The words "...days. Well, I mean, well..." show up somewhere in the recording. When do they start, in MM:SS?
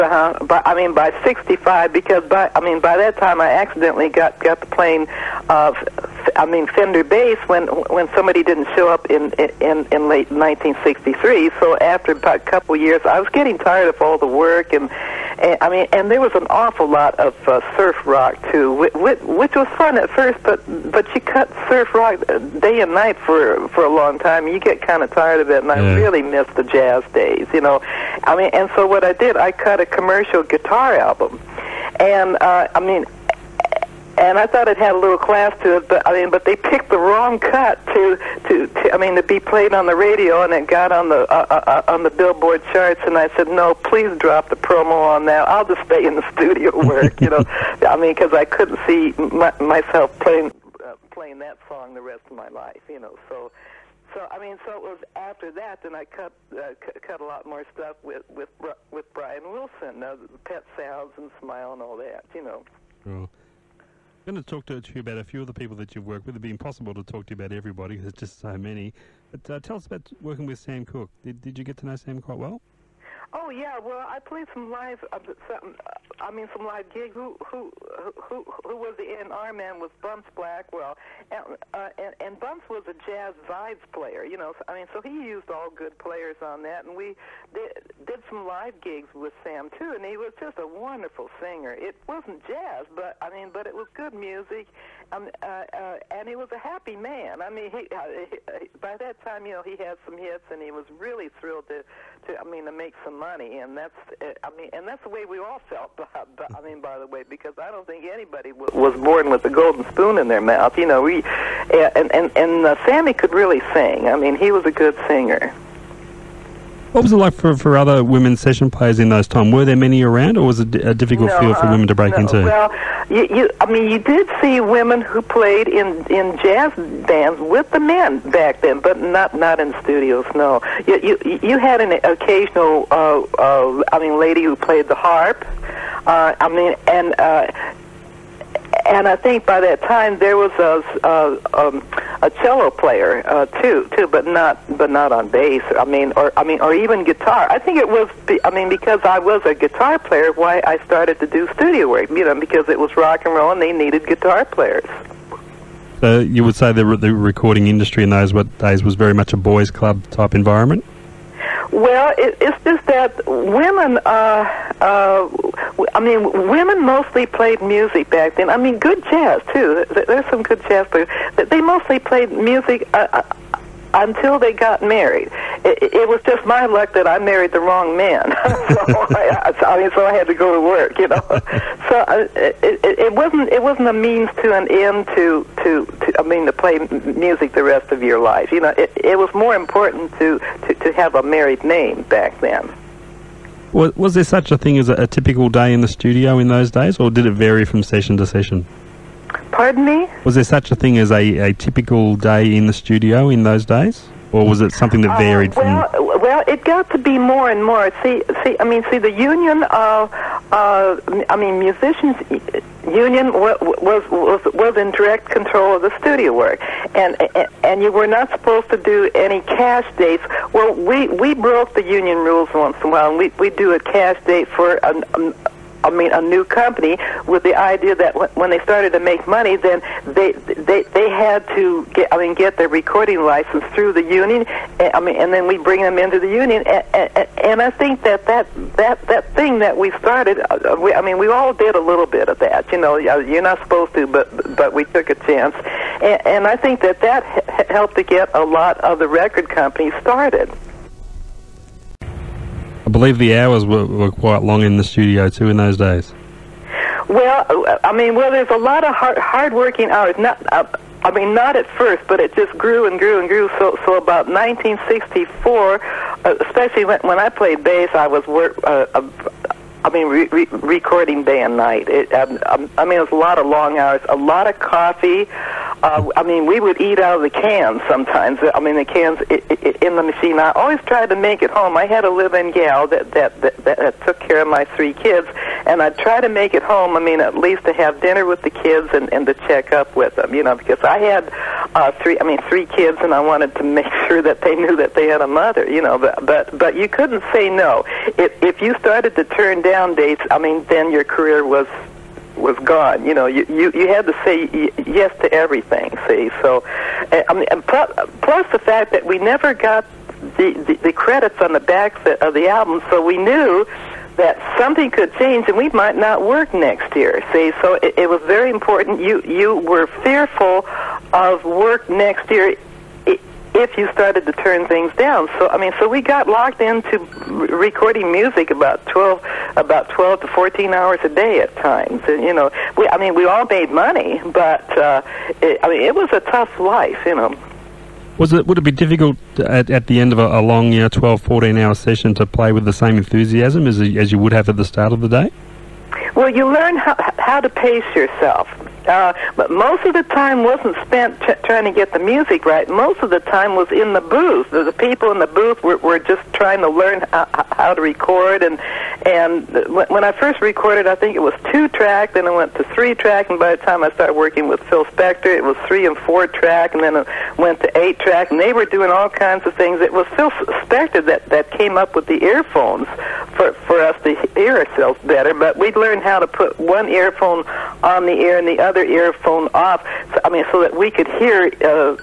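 04:15.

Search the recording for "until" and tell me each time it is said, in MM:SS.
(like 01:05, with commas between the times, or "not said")
02:53.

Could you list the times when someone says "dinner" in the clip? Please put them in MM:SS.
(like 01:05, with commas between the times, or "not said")
04:48.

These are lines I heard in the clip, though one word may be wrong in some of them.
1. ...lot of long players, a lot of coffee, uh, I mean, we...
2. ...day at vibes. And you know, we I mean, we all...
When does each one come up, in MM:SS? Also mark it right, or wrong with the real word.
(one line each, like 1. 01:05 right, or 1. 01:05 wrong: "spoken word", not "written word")
1. 04:33 wrong: "hours", not "players"
2. 05:31 wrong: "times", not "vibes".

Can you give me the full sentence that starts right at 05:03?
You know, you you, you had to say yes to everything.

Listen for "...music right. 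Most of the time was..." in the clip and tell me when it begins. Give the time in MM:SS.
05:51.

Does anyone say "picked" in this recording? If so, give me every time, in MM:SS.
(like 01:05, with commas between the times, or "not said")
00:36.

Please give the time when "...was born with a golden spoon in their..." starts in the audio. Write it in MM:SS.
01:48.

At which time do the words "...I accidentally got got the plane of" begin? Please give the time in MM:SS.
00:03.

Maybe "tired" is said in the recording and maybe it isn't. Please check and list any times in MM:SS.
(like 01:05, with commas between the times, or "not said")
00:13, 00:25.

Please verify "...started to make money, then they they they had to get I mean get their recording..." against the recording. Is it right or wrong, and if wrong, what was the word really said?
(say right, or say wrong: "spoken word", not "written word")
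right.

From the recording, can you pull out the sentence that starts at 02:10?
No, you you, you had an occasional, uh, uh, I mean, lady who played the harp.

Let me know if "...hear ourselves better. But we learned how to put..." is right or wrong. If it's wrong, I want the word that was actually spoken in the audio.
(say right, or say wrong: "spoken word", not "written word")
right.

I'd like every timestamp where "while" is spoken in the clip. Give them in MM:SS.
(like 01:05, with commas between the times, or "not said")
03:42.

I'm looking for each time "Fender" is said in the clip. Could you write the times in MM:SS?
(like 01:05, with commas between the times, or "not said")
00:06.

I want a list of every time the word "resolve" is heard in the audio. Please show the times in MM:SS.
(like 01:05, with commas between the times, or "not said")
not said.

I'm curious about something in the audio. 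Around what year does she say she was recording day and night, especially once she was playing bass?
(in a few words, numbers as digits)
1964.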